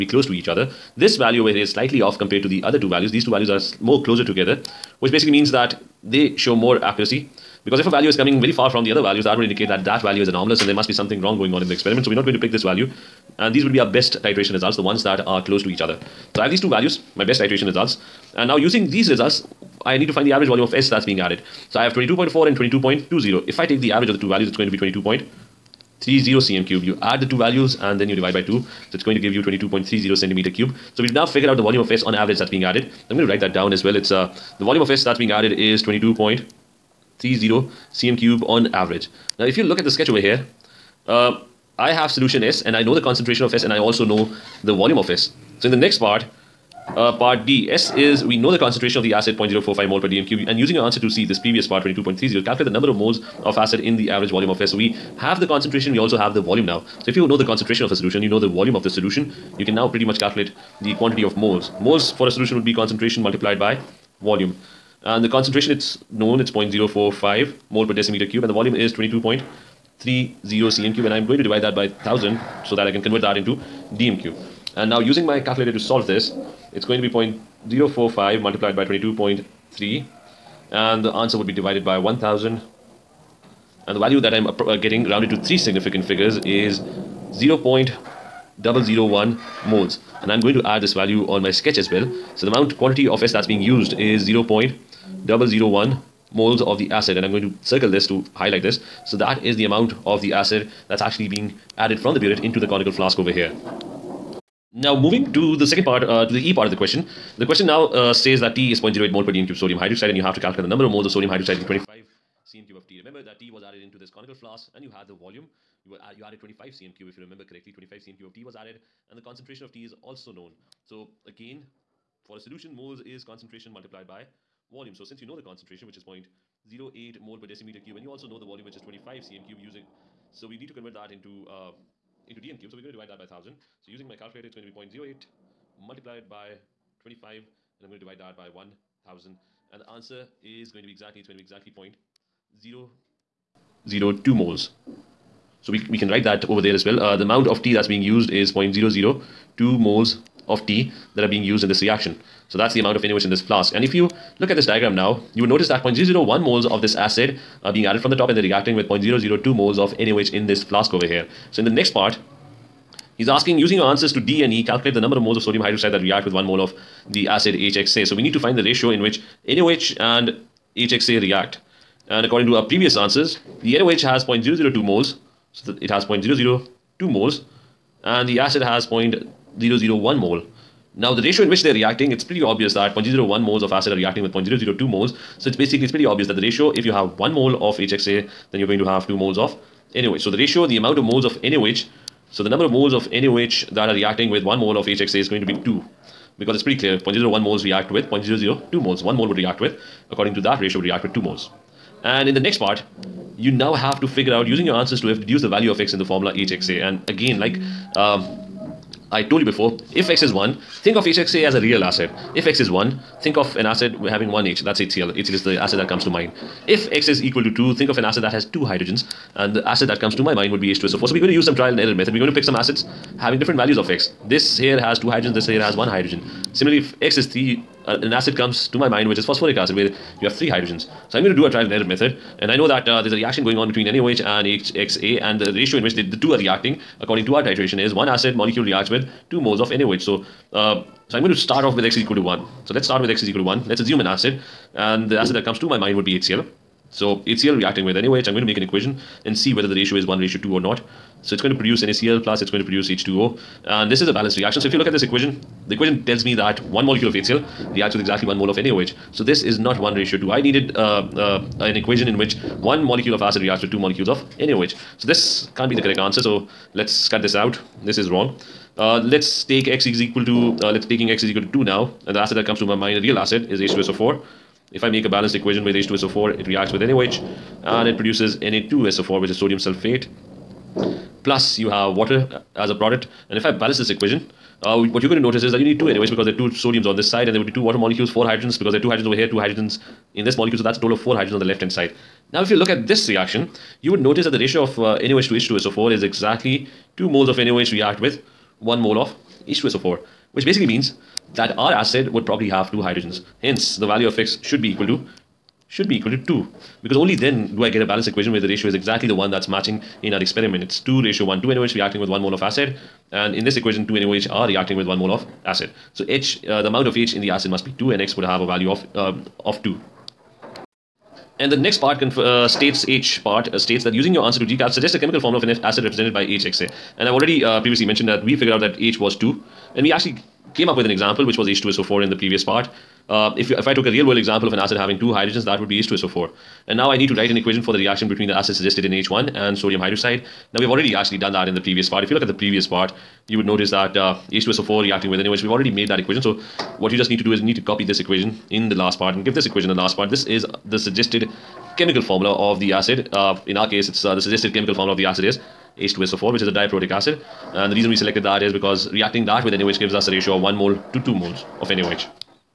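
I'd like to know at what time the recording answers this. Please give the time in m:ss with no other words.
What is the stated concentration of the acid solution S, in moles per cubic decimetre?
0:49.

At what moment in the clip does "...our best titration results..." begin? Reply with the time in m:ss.
0:13.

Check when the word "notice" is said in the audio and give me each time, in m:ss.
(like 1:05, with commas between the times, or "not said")
2:35, 4:45, 4:53, 5:43.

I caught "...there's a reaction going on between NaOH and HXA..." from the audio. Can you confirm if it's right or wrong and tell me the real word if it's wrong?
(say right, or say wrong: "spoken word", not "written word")
right.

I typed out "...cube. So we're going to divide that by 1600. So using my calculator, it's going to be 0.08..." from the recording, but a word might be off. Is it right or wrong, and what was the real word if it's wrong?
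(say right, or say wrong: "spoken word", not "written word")
wrong: "1000", not "1600".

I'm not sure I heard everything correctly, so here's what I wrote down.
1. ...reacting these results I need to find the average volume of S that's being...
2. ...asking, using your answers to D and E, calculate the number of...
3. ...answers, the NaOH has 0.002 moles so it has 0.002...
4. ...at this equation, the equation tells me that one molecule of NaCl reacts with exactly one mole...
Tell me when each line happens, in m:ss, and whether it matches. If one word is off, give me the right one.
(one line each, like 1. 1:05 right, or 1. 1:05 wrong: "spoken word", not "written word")
1. 0:18 wrong: "using", not "reacting"
2. 2:43 right
3. 2:52 right
4. 4:14 wrong: "HCl", not "NaCl".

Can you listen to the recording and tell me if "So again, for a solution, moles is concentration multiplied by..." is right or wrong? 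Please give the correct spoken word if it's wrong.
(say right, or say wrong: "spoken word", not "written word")
right.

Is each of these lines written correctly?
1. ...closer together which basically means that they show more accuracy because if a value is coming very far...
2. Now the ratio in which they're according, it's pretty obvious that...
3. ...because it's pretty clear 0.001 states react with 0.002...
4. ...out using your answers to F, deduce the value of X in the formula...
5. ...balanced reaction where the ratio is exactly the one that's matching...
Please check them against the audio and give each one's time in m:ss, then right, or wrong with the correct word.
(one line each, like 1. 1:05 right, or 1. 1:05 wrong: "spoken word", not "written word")
1. 0:04 right
2. 3:00 wrong: "reacting", not "according"
3. 3:16 wrong: "moles", not "states"
4. 3:24 right
5. 5:07 wrong: "equation", not "reaction".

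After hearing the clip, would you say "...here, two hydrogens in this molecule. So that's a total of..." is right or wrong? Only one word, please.
right.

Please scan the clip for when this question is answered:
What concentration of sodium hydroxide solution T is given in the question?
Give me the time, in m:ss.
1:48.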